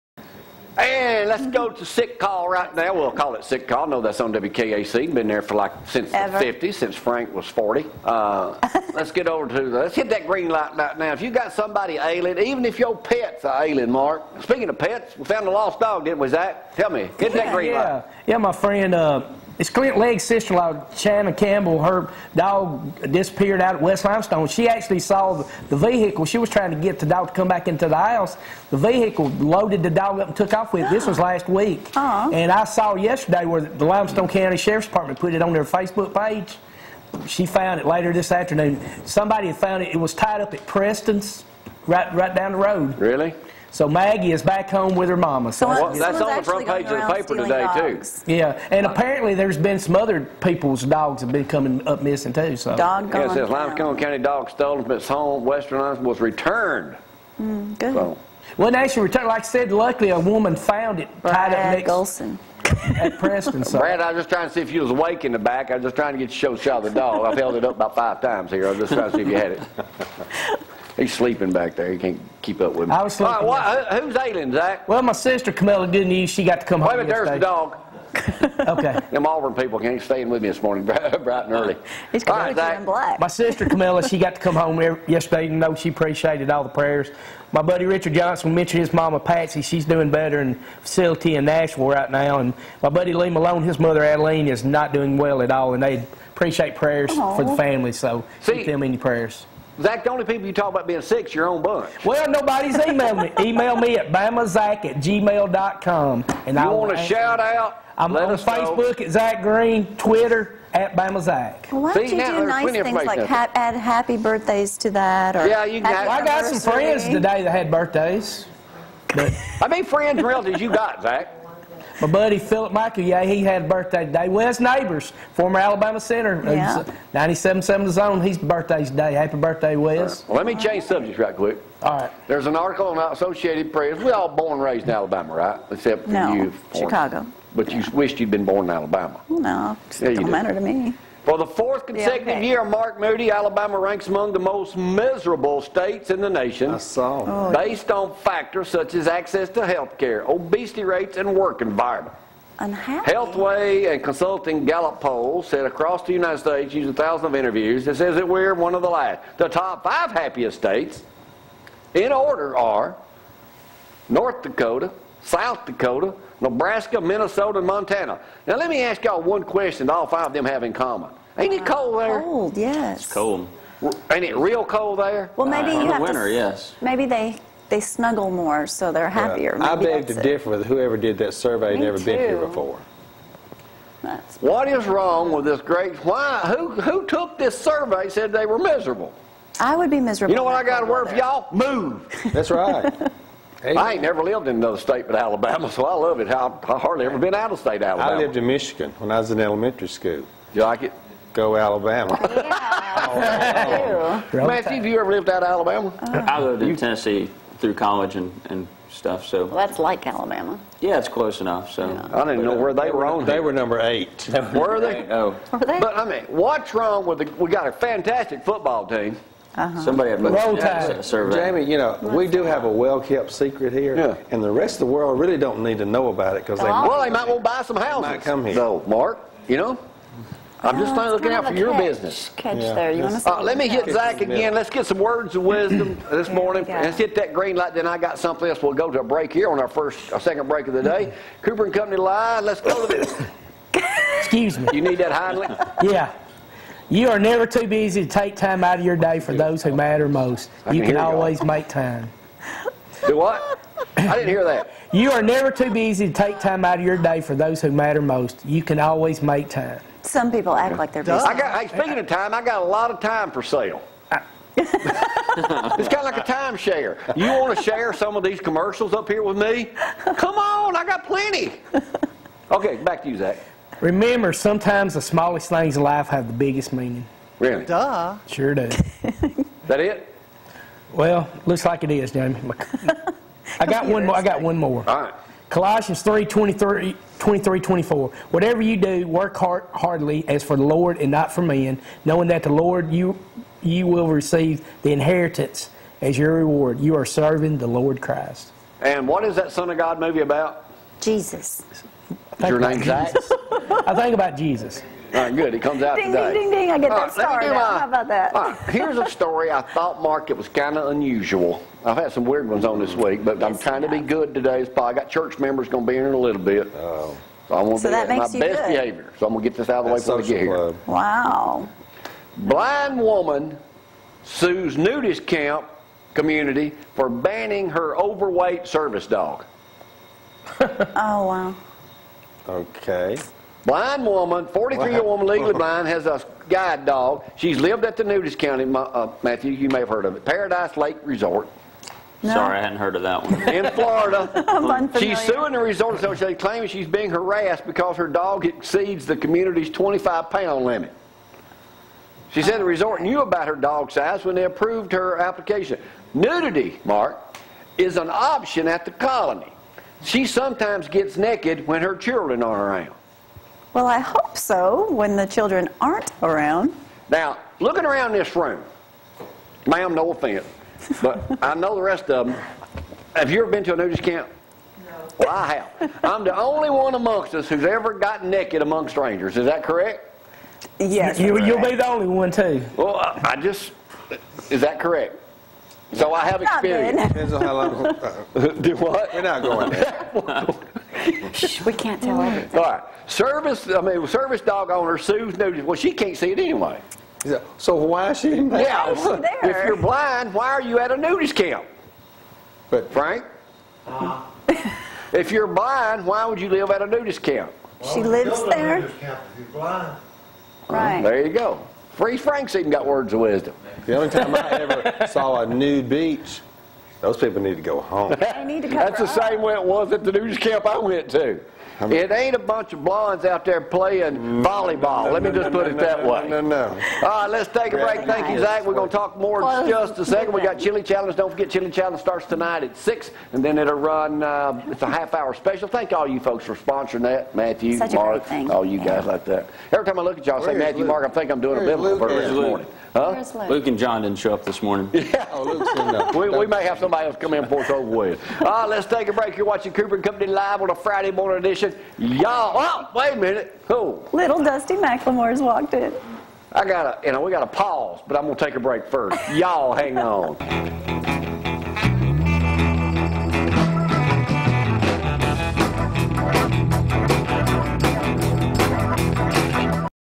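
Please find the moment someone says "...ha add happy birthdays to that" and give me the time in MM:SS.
01:53.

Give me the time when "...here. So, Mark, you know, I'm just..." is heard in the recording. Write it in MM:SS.
03:48.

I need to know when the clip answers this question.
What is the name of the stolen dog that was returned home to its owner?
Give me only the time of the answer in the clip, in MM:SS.
00:43.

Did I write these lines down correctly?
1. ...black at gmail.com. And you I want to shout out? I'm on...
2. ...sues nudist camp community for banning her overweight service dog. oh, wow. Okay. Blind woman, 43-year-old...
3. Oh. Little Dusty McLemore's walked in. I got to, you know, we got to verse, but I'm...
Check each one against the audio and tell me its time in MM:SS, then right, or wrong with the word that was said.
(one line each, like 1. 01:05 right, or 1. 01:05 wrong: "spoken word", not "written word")
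1. 01:44 wrong: "bamazack", not "black"
2. 05:24 right
3. 07:33 wrong: "pause", not "verse".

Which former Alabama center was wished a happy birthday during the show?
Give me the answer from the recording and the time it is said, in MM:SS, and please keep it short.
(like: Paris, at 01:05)
Wes Neighbors, at 02:04.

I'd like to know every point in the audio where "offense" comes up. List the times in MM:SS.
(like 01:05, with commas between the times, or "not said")
06:10.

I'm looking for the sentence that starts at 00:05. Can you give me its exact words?
Been there for like since Ever.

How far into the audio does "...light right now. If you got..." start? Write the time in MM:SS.
00:10.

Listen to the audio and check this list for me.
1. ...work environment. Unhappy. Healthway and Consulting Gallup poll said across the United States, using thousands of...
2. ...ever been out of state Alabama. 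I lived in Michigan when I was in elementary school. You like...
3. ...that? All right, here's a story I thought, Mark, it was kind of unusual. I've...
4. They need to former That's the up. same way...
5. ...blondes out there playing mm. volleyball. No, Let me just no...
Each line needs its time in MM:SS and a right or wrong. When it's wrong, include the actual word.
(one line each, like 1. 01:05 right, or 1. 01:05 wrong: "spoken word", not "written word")
1. 02:31 right
2. 03:17 right
3. 05:08 right
4. 06:58 wrong: "cover", not "former"
5. 07:02 right.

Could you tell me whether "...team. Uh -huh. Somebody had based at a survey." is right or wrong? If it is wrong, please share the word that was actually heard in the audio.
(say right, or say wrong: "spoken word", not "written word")
wrong: "looked", not "based".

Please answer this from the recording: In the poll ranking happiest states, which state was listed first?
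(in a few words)
North Dakota.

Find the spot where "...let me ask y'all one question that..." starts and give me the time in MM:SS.
02:48.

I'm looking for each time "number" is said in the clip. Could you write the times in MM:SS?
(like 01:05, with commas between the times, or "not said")
03:33.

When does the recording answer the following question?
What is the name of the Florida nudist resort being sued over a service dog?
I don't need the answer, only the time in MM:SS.
05:40.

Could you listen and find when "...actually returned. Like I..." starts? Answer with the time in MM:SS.
00:58.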